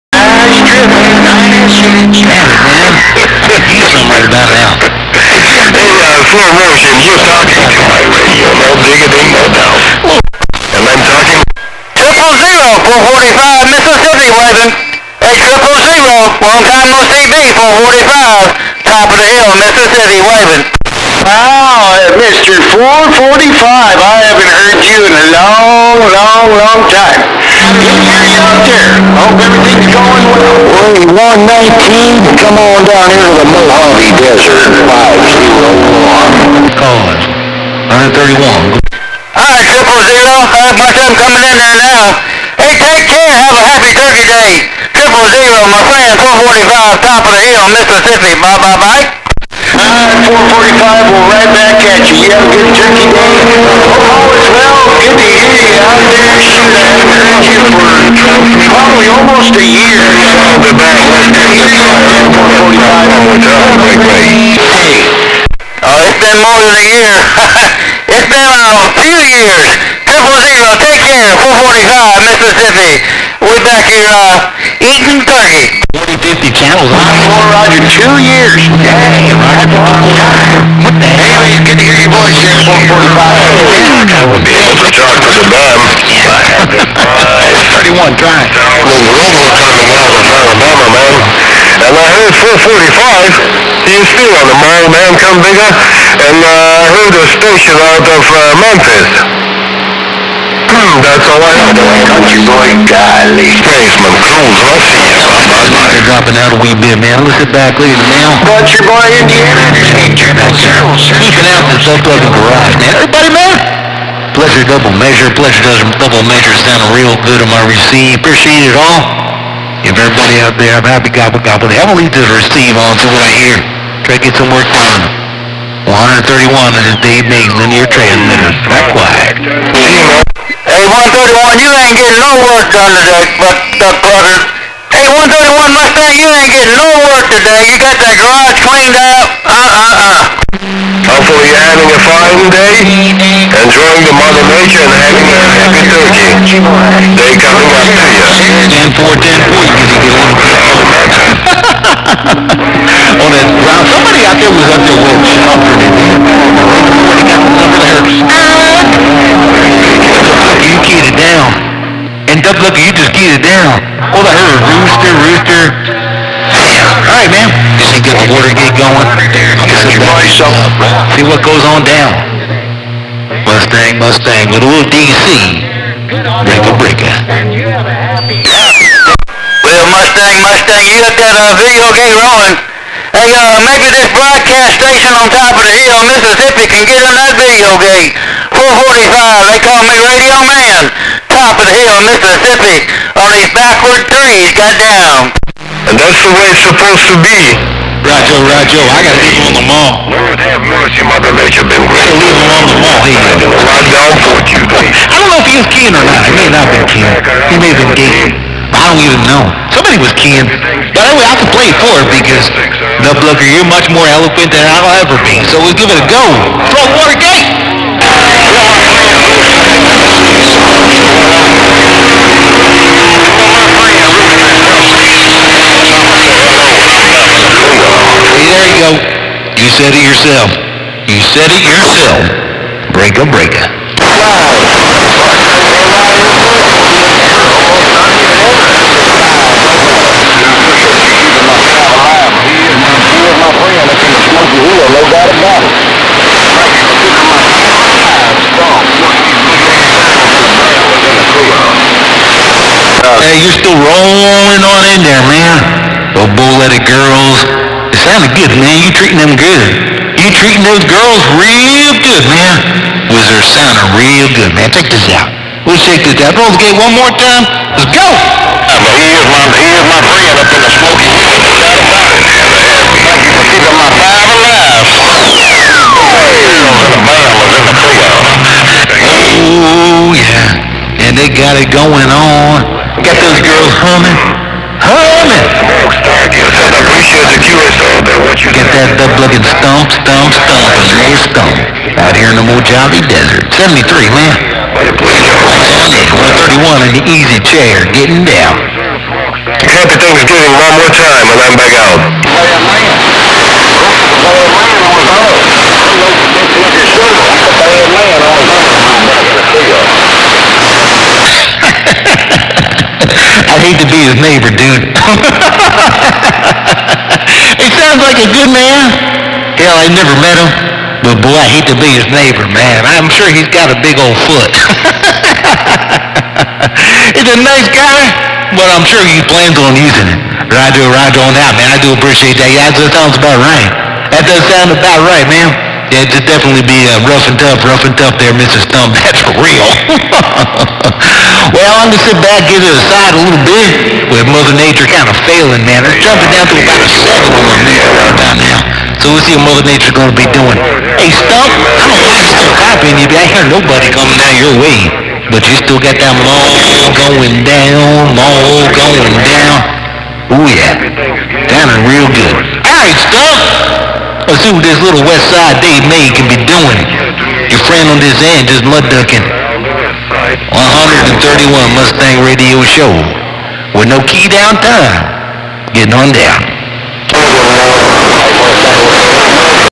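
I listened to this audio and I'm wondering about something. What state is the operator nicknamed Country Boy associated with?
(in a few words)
Indiana.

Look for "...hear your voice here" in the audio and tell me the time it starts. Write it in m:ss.
1:21.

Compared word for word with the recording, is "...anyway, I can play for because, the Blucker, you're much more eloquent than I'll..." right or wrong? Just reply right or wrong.
right.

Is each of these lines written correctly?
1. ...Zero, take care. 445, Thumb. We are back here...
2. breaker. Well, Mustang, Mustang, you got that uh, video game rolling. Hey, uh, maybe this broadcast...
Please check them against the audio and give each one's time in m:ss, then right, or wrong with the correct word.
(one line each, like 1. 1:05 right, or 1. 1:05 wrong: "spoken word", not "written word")
1. 1:10 wrong: "Mississippi", not "Thumb"
2. 2:56 right.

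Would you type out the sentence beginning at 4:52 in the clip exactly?
Out here in the Mojave Desert.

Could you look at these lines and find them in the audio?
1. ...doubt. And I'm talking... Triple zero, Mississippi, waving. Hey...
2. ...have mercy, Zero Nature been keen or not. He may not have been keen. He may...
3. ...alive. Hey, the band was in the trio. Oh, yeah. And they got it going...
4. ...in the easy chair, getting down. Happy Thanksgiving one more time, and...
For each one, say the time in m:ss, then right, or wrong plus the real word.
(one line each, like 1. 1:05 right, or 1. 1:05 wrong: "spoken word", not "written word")
1. 0:09 right
2. 3:20 wrong: "Mother", not "Zero"
3. 4:34 right
4. 4:56 right.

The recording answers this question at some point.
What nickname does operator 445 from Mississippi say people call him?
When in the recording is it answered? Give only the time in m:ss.
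3:10.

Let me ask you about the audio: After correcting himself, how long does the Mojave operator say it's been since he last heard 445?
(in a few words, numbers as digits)
2 years.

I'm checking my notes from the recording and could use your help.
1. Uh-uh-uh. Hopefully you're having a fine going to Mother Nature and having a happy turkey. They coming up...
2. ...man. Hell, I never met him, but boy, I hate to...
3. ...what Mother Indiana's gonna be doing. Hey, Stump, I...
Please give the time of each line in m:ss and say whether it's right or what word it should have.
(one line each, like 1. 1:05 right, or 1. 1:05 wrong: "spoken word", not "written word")
1. 2:19 right
2. 5:18 right
3. 5:49 wrong: "Nature", not "Indiana".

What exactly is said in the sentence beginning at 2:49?
Get your voice See what goes on down.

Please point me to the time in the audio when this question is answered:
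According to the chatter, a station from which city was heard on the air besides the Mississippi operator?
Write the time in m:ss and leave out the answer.
1:38.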